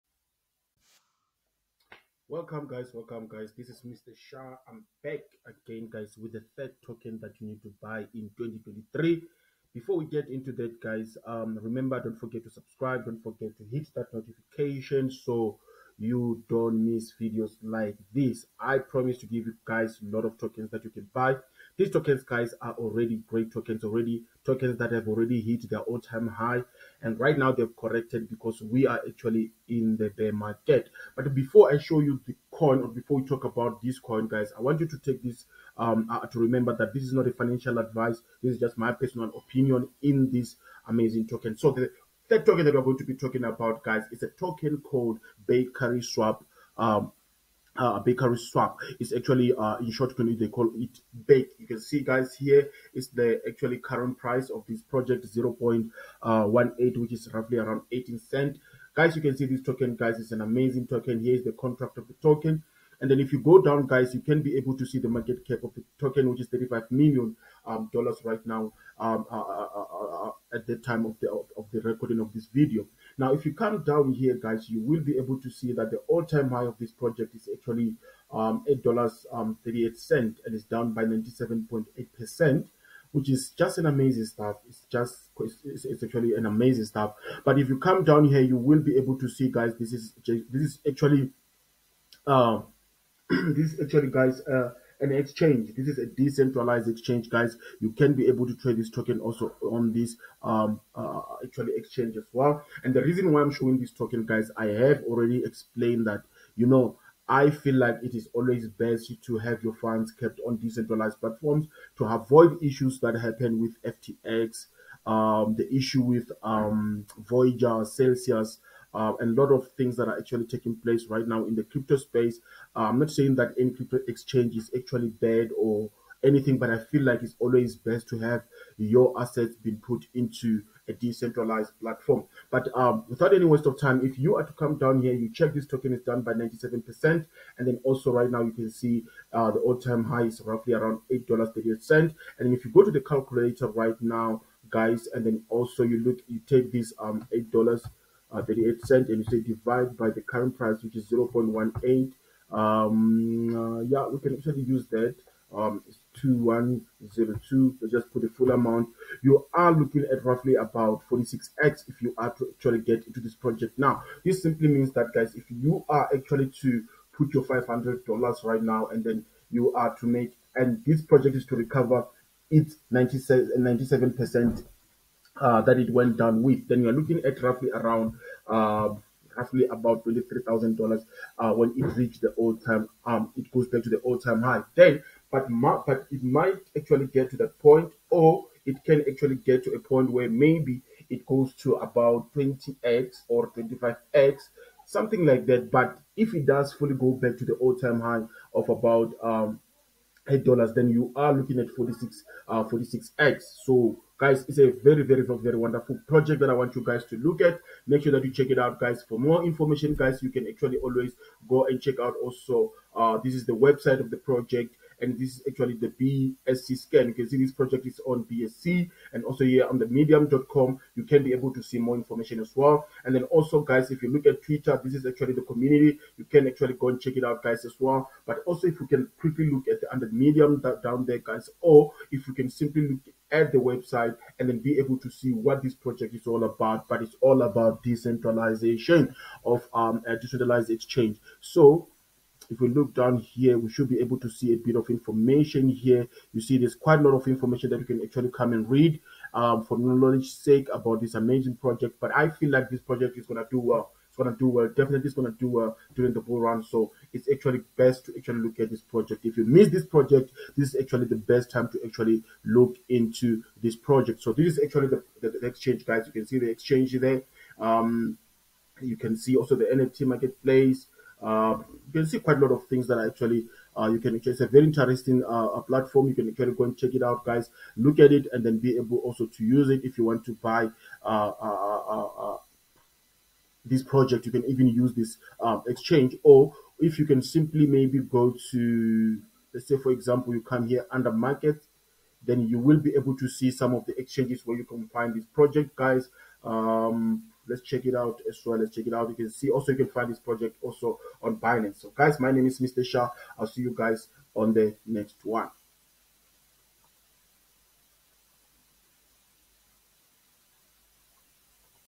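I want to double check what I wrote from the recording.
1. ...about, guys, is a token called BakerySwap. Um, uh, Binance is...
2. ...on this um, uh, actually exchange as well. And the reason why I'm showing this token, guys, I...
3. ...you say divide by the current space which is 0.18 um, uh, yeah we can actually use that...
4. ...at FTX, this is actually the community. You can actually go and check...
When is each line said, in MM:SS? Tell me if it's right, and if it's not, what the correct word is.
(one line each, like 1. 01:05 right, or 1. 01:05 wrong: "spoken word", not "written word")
1. 00:43 wrong: "BakerySwap", not "Binance"
2. 01:39 right
3. 02:29 wrong: "price", not "space"
4. 03:44 wrong: "Twitter", not "FTX".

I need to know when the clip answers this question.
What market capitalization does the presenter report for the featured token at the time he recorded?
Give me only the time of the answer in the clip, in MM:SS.
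01:06.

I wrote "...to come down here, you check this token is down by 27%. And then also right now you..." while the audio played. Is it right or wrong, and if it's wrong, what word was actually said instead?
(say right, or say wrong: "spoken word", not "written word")
wrong: "97", not "27".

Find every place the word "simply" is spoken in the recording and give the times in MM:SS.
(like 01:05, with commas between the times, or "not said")
02:44, 03:52, 04:47.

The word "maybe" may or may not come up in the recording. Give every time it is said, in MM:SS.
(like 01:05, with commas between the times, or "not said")
03:10, 04:47.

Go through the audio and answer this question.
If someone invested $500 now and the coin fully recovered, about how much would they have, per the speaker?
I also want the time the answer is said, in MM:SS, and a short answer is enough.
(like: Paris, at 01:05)
$23,000, at 03:00.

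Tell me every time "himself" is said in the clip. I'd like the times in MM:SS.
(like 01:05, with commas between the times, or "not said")
not said.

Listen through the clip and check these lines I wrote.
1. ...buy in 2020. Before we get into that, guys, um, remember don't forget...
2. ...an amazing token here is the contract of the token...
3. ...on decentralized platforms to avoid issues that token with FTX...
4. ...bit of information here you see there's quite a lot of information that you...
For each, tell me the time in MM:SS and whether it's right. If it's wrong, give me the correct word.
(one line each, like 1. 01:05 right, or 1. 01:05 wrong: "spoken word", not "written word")
1. 00:07 wrong: "2023", not "2020"
2. 01:00 right
3. 01:50 wrong: "happen", not "token"
4. 04:04 right.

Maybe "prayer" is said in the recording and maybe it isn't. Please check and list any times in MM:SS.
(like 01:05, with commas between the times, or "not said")
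not said.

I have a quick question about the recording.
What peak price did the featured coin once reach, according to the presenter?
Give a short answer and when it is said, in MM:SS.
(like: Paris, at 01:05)
$8.38, at 01:18.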